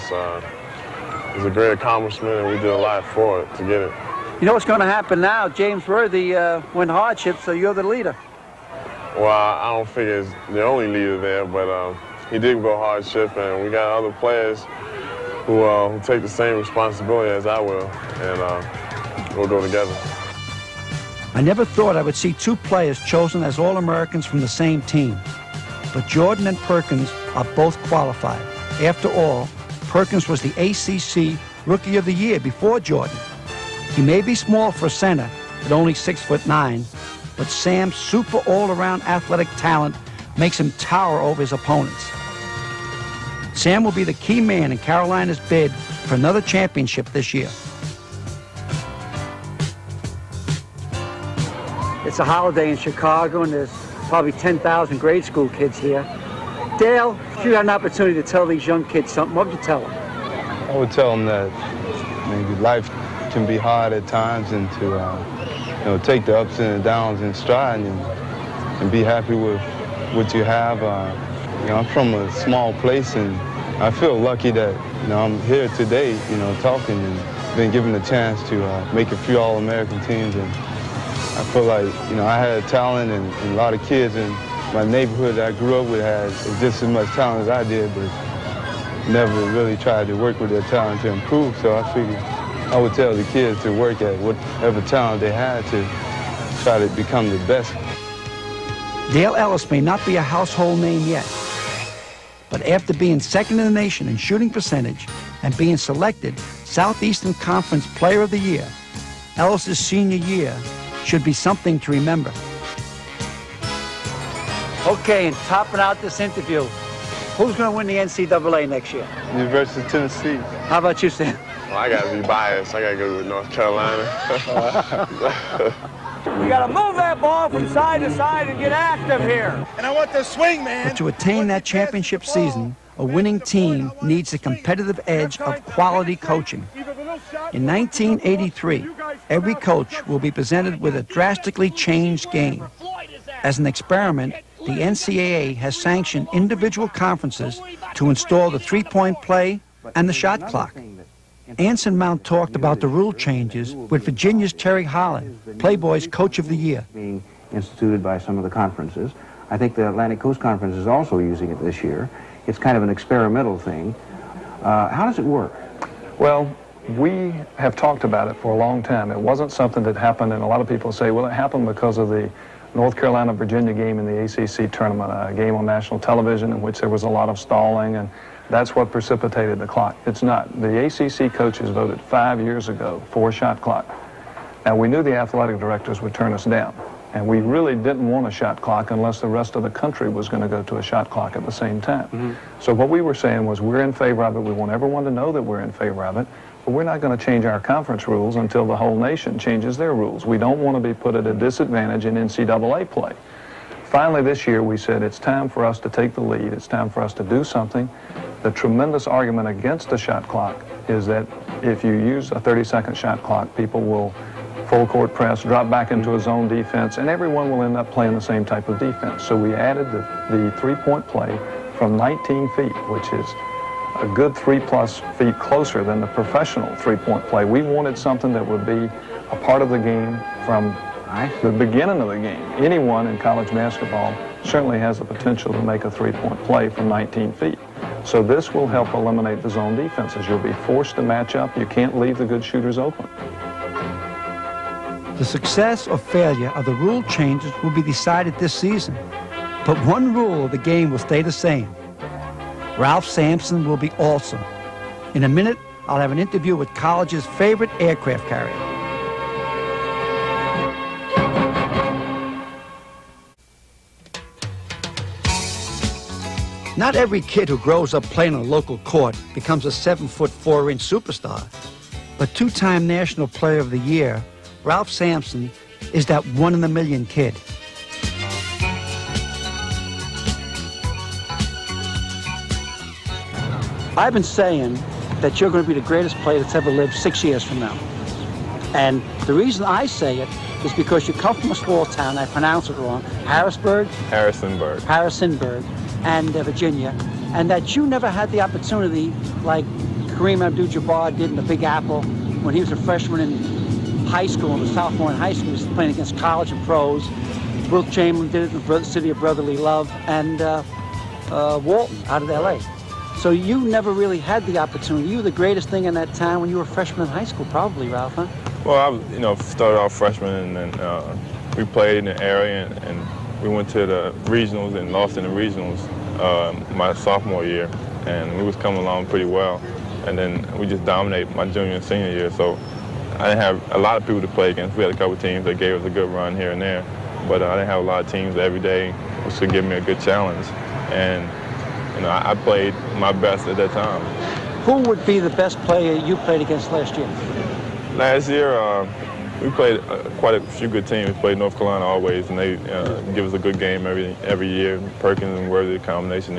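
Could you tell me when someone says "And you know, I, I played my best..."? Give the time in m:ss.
5:40.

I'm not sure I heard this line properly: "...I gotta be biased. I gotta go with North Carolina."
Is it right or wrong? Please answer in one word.
right.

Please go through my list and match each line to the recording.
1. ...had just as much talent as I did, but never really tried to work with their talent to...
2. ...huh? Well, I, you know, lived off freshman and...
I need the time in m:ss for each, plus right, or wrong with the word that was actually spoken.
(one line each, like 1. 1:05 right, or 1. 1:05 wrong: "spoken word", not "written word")
1. 1:26 right
2. 5:18 wrong: "started", not "lived".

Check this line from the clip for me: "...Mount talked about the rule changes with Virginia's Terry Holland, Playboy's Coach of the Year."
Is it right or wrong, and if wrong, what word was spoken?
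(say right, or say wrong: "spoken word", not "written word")
right.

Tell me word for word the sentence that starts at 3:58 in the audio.
So this will help eliminate the zone defenses.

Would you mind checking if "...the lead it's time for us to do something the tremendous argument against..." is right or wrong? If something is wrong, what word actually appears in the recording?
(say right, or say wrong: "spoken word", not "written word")
right.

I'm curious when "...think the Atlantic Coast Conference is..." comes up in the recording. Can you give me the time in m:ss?
2:39.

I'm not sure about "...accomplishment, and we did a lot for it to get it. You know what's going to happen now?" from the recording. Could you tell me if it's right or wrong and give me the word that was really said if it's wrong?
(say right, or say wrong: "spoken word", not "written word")
right.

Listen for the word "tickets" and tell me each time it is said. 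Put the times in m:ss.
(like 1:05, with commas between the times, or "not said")
not said.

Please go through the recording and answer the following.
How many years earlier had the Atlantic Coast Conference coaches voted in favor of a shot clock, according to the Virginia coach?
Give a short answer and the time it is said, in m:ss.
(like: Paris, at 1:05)
5, at 3:02.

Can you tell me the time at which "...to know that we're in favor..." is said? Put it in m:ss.
3:15.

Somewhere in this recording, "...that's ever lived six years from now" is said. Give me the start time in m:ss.
4:46.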